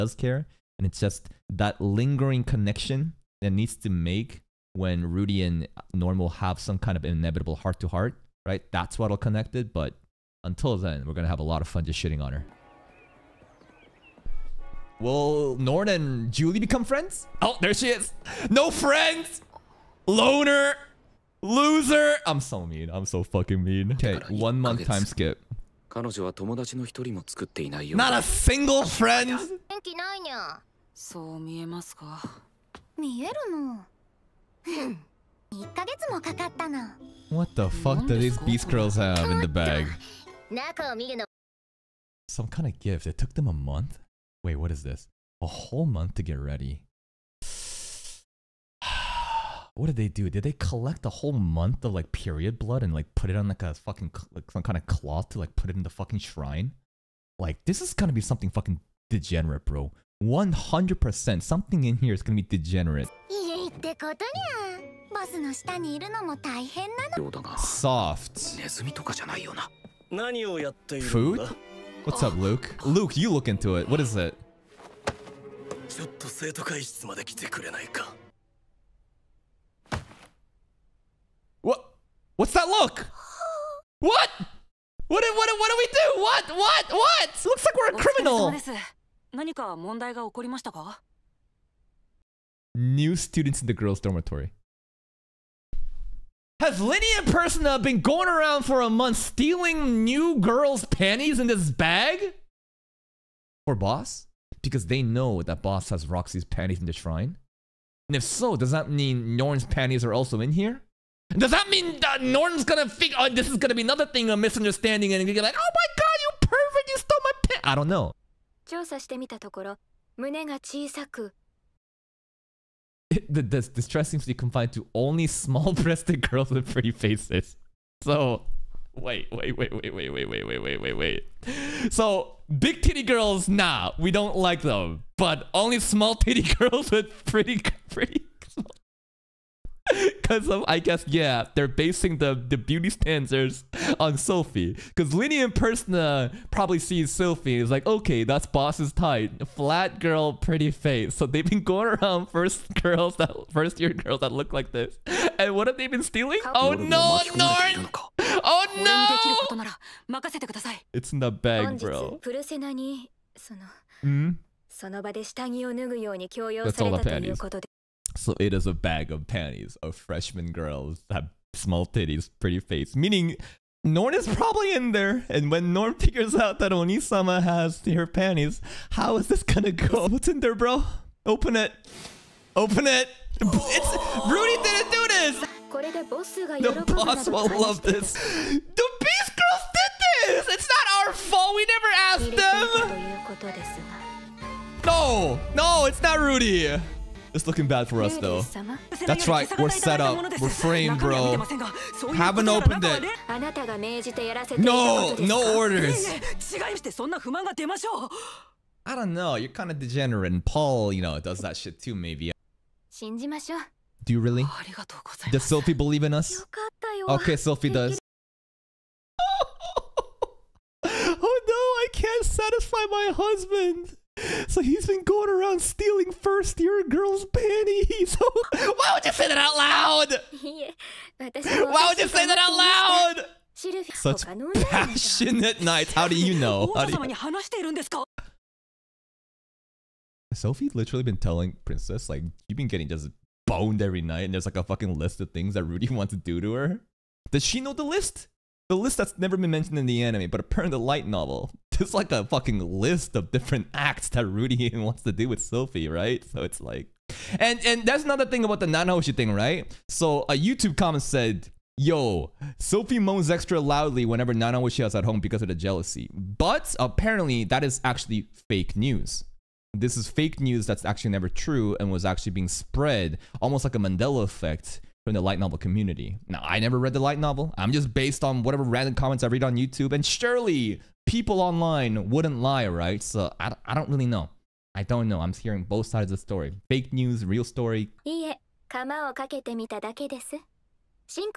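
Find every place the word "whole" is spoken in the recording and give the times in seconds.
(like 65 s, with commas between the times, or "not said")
45 s, 51 s.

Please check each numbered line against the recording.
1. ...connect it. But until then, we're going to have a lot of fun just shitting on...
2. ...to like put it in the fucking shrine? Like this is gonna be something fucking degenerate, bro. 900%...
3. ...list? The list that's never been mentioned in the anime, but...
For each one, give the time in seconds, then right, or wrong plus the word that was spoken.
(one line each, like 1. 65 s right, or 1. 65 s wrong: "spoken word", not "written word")
1. 9 s right
2. 55 s wrong: "100", not "900"
3. 247 s right.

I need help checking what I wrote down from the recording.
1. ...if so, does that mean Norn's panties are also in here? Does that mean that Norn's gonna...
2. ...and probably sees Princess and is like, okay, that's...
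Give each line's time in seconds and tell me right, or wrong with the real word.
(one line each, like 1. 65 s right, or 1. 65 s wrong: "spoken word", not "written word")
1. 108 s right
2. 145 s wrong: "Sophie", not "Princess".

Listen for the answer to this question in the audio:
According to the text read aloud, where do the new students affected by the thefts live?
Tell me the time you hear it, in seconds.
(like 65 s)
93 s.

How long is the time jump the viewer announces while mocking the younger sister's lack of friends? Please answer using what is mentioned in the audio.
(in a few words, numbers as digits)
One month.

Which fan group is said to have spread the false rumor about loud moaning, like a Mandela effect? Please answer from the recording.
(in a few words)
The light novel community.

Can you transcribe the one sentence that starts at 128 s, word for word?
So wait, wait, wait, wait, wait, wait, wait, wait, wait, wait, wait.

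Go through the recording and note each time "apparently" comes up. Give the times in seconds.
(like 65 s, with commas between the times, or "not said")
250 s, 266 s.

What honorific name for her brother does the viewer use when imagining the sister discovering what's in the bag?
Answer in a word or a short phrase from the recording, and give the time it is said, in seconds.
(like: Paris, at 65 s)
Onisama, at 176 s.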